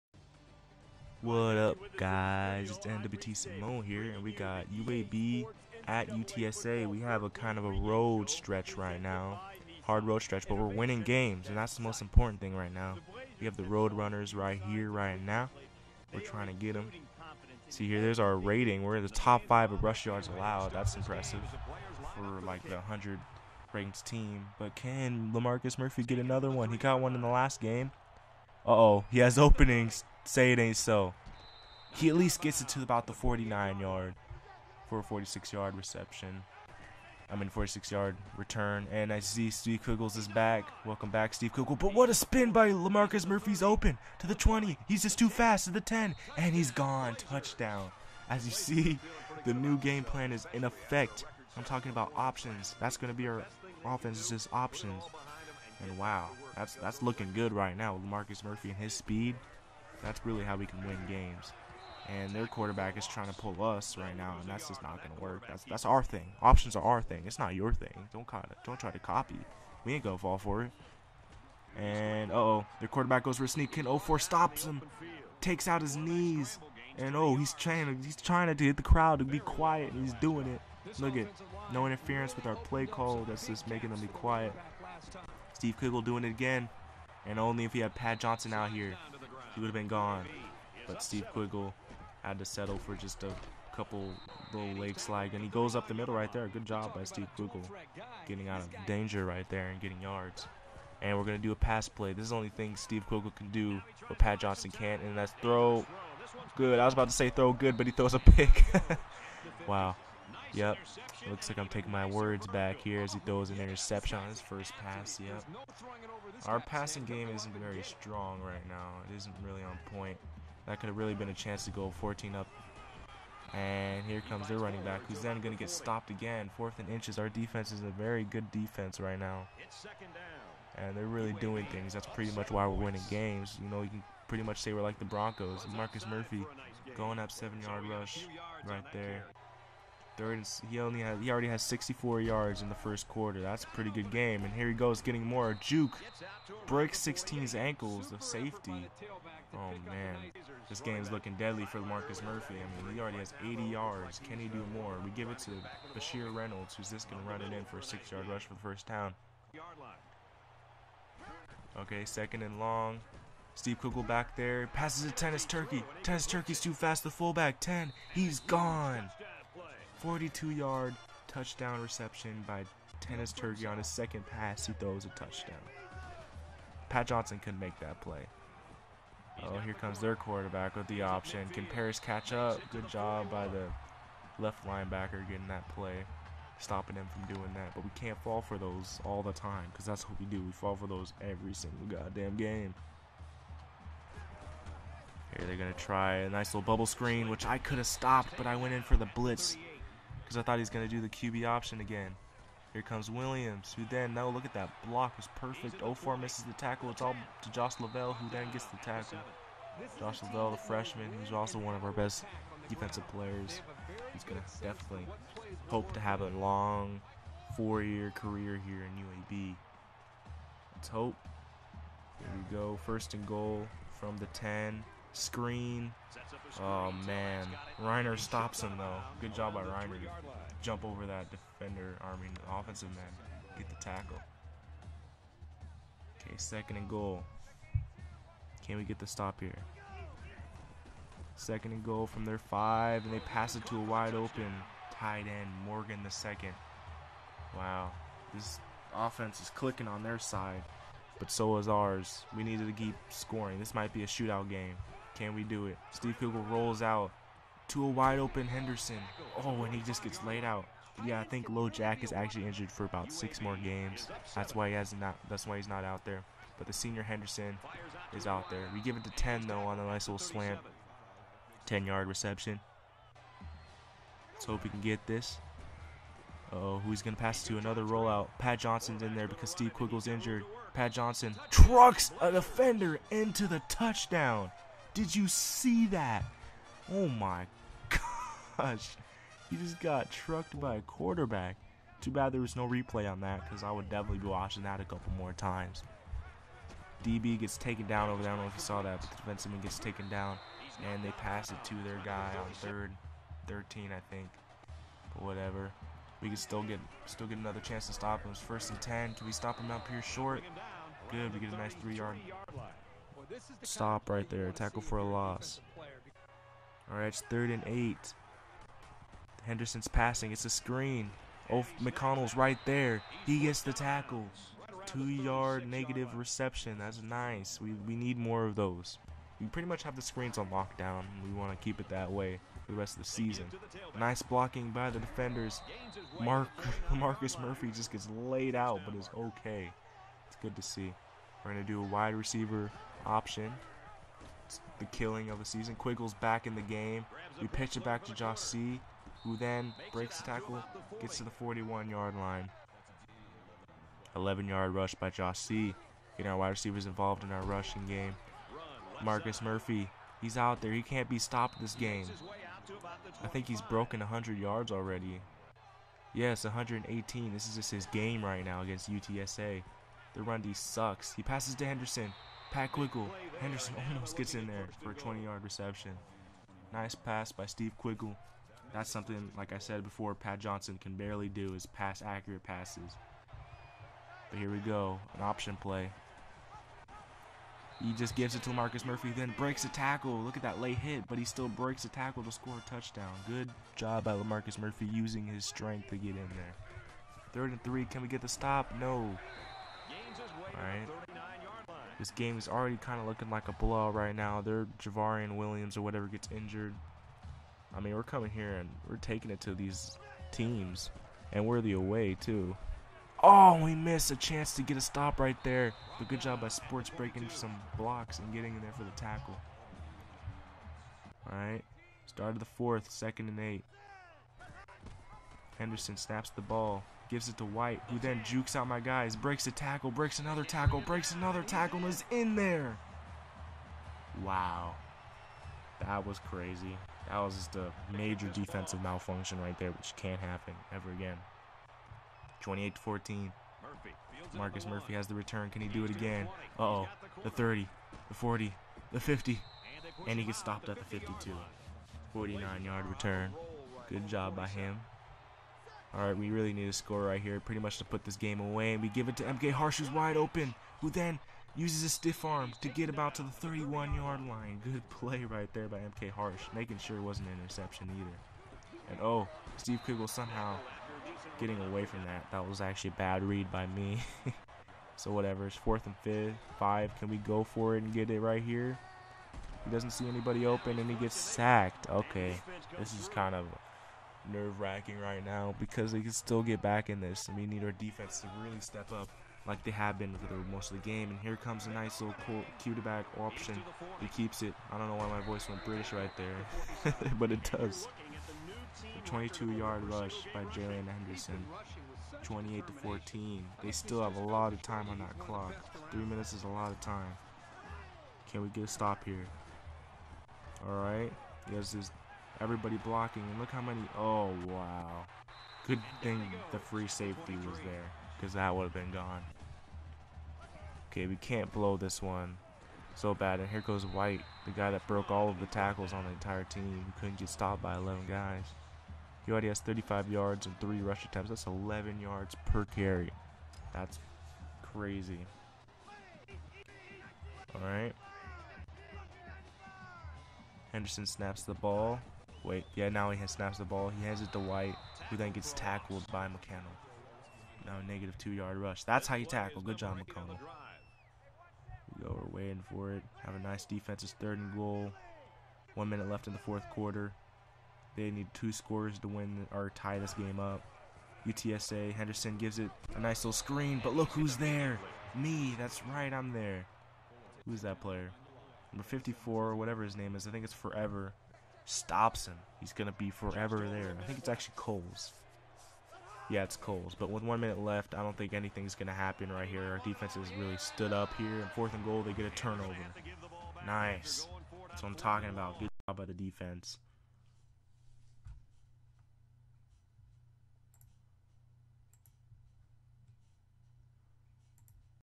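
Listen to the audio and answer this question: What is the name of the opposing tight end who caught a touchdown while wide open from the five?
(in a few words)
Morgan the second.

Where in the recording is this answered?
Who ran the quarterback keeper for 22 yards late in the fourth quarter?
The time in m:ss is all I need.
8:20.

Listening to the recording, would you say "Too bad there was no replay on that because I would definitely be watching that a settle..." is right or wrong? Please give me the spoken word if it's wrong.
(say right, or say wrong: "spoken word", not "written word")
wrong: "couple", not "settle".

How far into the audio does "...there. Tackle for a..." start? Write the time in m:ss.
5:14.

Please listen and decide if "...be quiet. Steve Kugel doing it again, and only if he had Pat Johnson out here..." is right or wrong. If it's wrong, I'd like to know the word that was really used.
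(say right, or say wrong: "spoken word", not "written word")
right.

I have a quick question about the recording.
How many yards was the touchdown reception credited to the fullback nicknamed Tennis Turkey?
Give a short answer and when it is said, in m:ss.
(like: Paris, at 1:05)
42, at 2:50.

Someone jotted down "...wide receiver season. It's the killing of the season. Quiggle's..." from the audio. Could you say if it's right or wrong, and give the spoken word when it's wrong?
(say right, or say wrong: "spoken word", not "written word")
wrong: "option", not "season".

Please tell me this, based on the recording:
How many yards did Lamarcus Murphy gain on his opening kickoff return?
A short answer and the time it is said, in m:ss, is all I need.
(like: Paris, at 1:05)
46, at 0:37.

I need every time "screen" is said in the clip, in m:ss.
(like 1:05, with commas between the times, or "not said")
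3:16, 3:45, 5:20, 5:30, 9:23.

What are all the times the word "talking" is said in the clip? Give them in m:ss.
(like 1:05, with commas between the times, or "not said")
0:51, 9:44.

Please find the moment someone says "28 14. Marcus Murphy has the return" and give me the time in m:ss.
7:22.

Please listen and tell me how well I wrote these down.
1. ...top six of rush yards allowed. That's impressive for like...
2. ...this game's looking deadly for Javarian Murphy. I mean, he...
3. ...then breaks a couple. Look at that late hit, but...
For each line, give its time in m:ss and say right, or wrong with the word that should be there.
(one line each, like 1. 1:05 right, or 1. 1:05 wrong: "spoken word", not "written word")
1. 0:19 wrong: "five", not "six"
2. 2:30 wrong: "Marcus", not "Javarian"
3. 6:29 wrong: "tackle", not "couple".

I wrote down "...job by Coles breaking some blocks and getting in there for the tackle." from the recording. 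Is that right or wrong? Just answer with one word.
wrong.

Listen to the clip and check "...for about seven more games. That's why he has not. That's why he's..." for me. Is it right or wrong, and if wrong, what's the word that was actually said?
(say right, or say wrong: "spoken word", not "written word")
wrong: "six", not "seven".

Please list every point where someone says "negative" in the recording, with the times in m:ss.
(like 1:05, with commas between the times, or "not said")
5:25, 9:07.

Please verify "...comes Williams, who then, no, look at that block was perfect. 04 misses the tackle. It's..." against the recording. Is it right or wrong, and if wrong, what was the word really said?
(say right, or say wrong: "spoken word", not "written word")
right.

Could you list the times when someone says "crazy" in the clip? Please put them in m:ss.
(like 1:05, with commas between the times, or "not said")
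7:16, 8:54.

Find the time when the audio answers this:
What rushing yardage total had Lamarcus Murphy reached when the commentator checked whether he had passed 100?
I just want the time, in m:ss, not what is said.
6:06.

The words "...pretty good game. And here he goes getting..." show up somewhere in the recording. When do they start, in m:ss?
2:23.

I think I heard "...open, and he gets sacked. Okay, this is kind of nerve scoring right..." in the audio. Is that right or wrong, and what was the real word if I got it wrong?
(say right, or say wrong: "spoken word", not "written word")
wrong: "wracking", not "scoring".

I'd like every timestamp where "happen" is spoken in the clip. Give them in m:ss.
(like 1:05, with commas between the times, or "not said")
7:20, 9:38.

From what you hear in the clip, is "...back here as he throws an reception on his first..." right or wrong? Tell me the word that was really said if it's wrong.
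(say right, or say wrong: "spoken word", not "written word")
wrong: "interception", not "reception".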